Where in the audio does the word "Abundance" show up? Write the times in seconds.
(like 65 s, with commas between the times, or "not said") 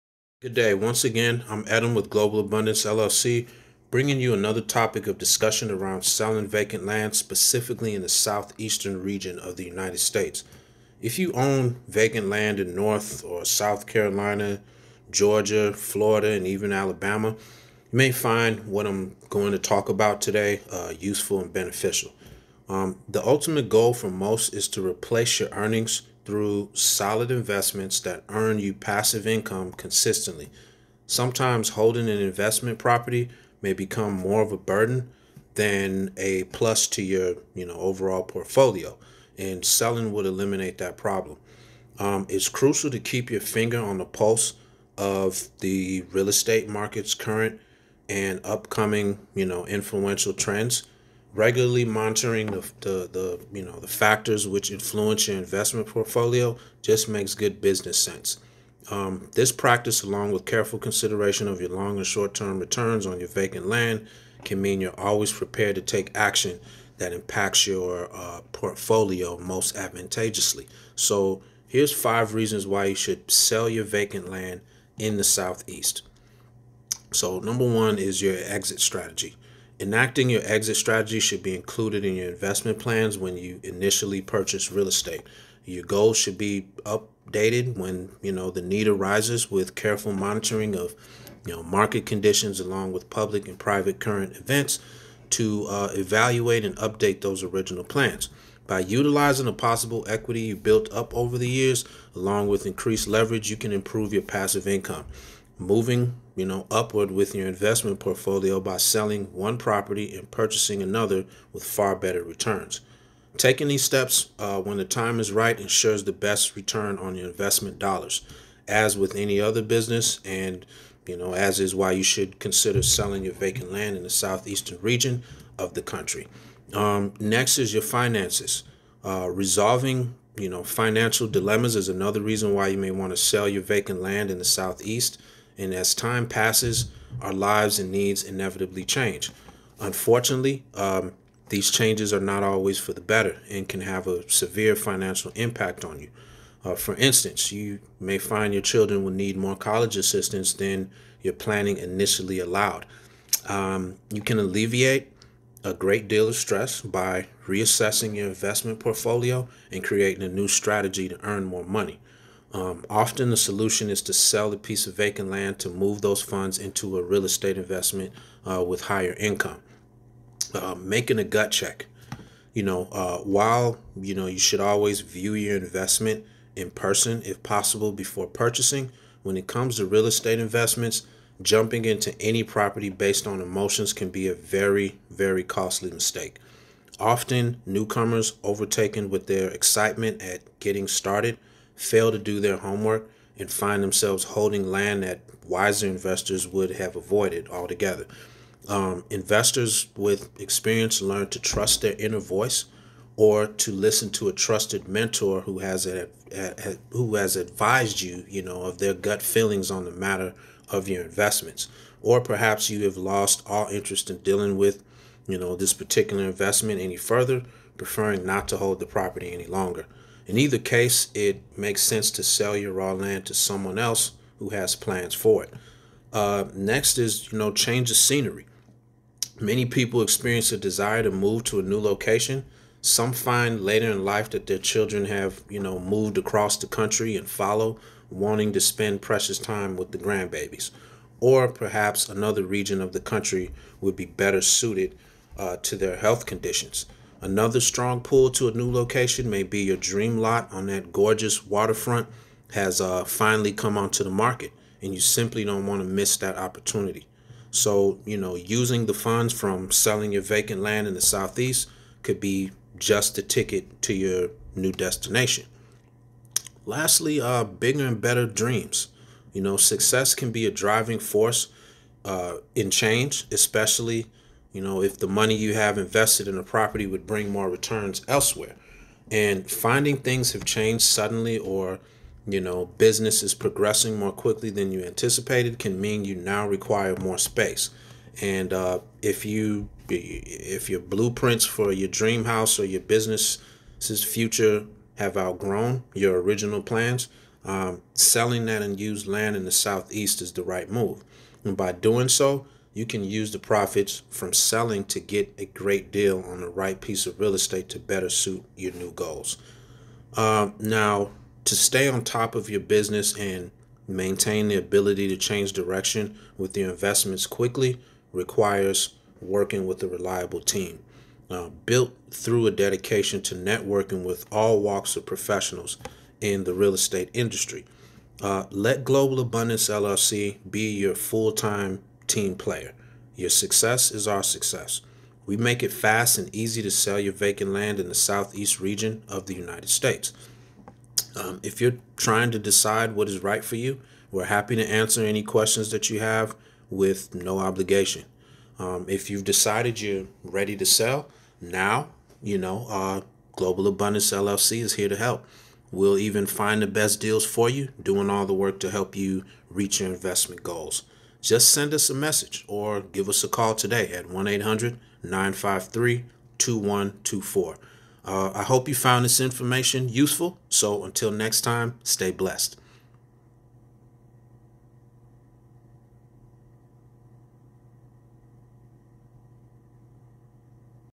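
2 s, 329 s, 353 s.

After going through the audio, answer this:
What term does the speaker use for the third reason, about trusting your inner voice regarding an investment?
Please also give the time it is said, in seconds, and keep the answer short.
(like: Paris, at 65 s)
Gut check, at 171 s.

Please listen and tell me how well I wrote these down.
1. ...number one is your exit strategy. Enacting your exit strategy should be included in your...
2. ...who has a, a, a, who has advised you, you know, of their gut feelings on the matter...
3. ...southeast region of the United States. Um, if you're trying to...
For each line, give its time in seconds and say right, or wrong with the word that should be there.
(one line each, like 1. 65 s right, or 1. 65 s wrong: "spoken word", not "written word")
1. 77 s right
2. 205 s right
3. 337 s right.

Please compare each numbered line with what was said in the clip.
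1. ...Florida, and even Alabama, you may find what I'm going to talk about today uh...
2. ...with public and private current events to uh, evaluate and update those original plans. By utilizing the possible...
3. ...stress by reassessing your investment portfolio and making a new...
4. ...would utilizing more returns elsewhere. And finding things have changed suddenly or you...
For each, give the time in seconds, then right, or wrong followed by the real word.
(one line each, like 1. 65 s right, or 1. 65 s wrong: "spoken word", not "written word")
1. 15 s right
2. 92 s right
3. 156 s wrong: "creating", not "making"
4. 276 s wrong: "bring", not "utilizing".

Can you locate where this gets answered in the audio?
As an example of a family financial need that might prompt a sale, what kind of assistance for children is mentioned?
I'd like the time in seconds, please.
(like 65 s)
149 s.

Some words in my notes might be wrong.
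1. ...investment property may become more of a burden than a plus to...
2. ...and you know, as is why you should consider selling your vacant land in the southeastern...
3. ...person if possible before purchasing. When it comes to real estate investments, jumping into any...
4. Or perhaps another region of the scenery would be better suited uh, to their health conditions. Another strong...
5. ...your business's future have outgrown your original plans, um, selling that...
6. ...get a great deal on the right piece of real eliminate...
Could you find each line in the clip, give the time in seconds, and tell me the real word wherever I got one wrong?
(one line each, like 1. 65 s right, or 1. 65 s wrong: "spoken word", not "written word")
1. 32 s right
2. 120 s right
3. 176 s right
4. 241 s wrong: "country", not "scenery"
5. 292 s right
6. 304 s wrong: "estate", not "eliminate".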